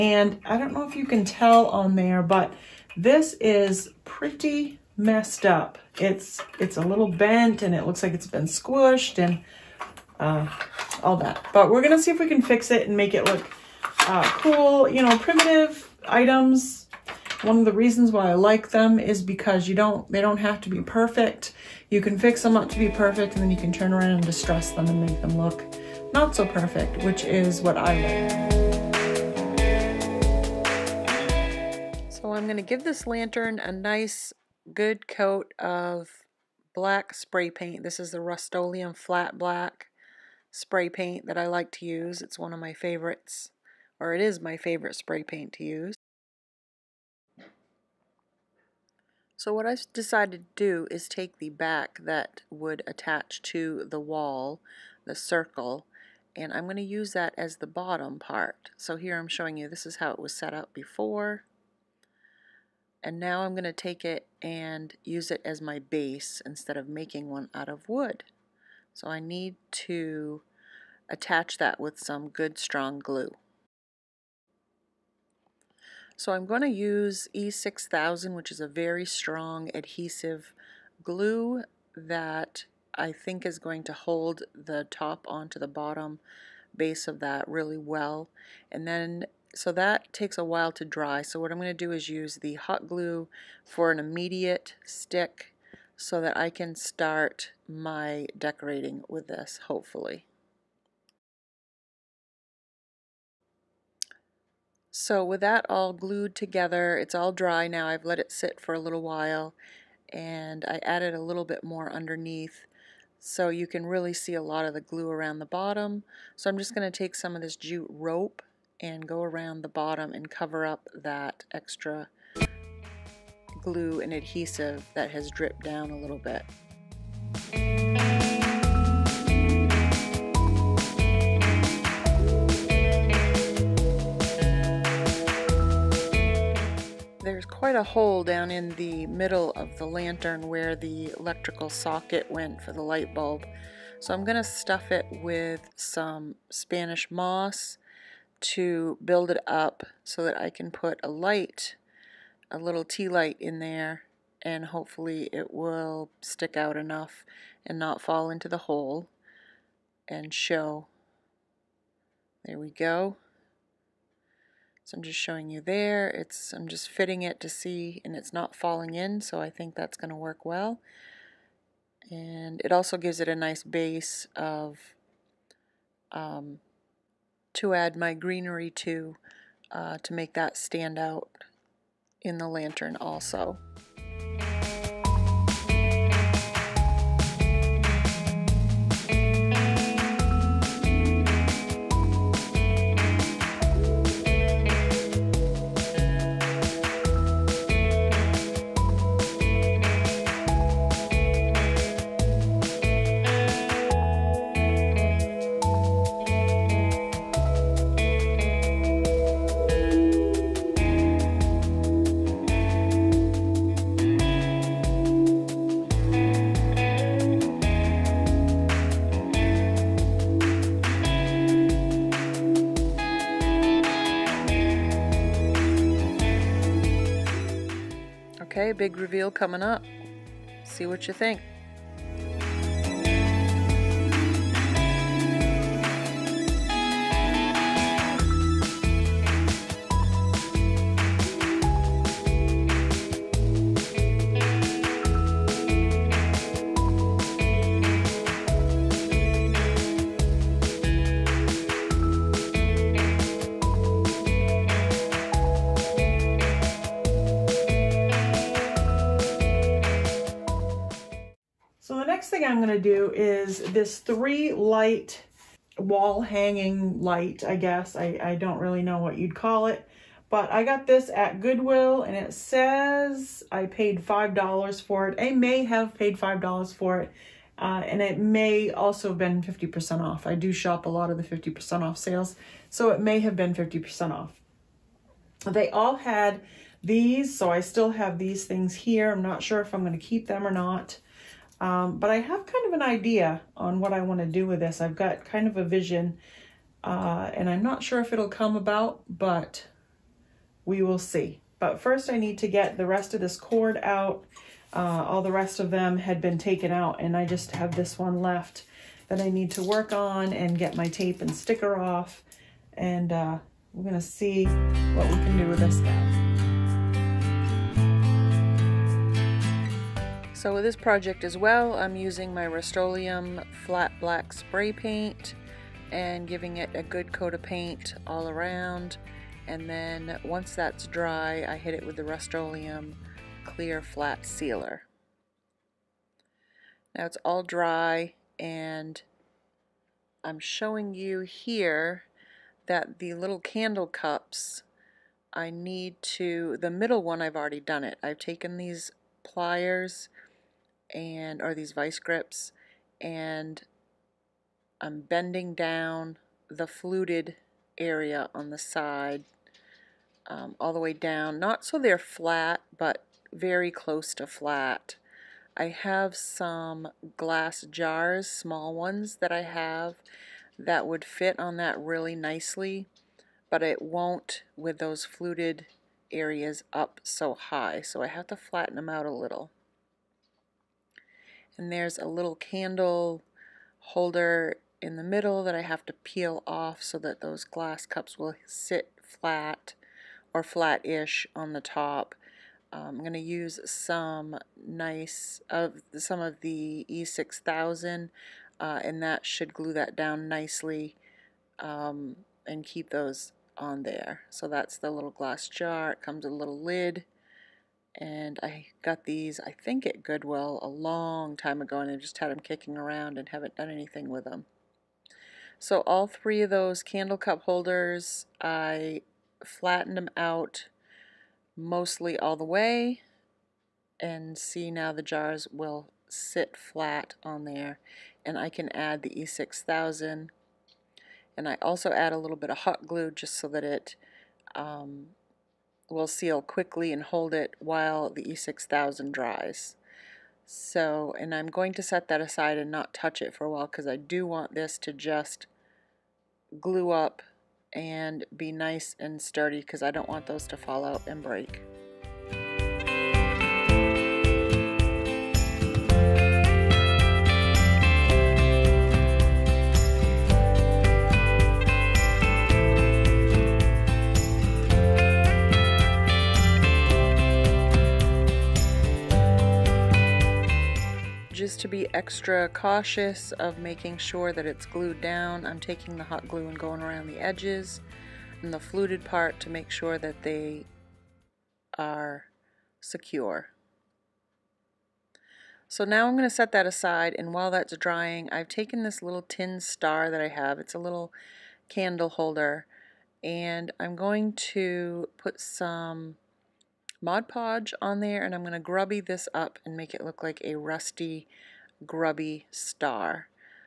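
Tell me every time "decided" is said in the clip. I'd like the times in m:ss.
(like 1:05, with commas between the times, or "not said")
0:49.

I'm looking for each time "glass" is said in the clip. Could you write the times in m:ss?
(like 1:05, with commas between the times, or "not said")
6:07, 6:27, 6:45.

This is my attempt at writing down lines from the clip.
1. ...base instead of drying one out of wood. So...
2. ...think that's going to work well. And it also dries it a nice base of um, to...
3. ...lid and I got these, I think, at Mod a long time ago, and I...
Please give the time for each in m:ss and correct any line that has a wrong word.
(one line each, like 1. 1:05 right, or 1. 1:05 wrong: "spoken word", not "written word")
1. 1:05 wrong: "making", not "drying"
2. 2:49 wrong: "gives", not "dries"
3. 6:46 wrong: "Goodwill", not "Mod".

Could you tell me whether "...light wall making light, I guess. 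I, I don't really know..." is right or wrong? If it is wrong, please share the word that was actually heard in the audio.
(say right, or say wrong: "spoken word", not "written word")
wrong: "hanging", not "making".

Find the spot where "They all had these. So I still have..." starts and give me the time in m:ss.
4:45.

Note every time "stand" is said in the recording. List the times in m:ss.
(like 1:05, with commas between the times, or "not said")
3:00.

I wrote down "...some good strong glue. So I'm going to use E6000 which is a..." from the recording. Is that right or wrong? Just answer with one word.
right.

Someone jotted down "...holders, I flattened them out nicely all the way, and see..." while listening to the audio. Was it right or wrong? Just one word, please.
wrong.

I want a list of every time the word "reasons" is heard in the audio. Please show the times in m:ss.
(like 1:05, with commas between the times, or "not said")
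0:17.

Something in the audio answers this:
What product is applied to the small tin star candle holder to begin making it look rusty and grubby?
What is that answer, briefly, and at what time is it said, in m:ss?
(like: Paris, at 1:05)
Mod Podge, at 8:17.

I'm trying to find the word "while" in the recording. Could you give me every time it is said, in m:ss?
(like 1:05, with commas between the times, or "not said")
1:30, 1:49, 7:17, 7:23, 8:07.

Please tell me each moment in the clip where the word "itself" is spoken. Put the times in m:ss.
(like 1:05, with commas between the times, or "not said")
not said.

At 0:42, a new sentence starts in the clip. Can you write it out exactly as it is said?
It's one of my favorites, or it is my favorite spray paint to use.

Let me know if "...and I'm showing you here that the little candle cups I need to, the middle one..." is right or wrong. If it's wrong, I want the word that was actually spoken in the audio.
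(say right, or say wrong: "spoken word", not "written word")
right.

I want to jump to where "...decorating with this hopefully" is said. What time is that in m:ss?
1:38.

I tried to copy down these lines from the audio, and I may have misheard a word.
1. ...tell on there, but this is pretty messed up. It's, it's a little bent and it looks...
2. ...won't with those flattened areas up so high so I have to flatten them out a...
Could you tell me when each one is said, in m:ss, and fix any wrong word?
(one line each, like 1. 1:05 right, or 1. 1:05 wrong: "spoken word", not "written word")
1. 0:01 right
2. 6:13 wrong: "fluted", not "flattened".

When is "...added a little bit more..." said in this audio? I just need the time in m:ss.
1:50.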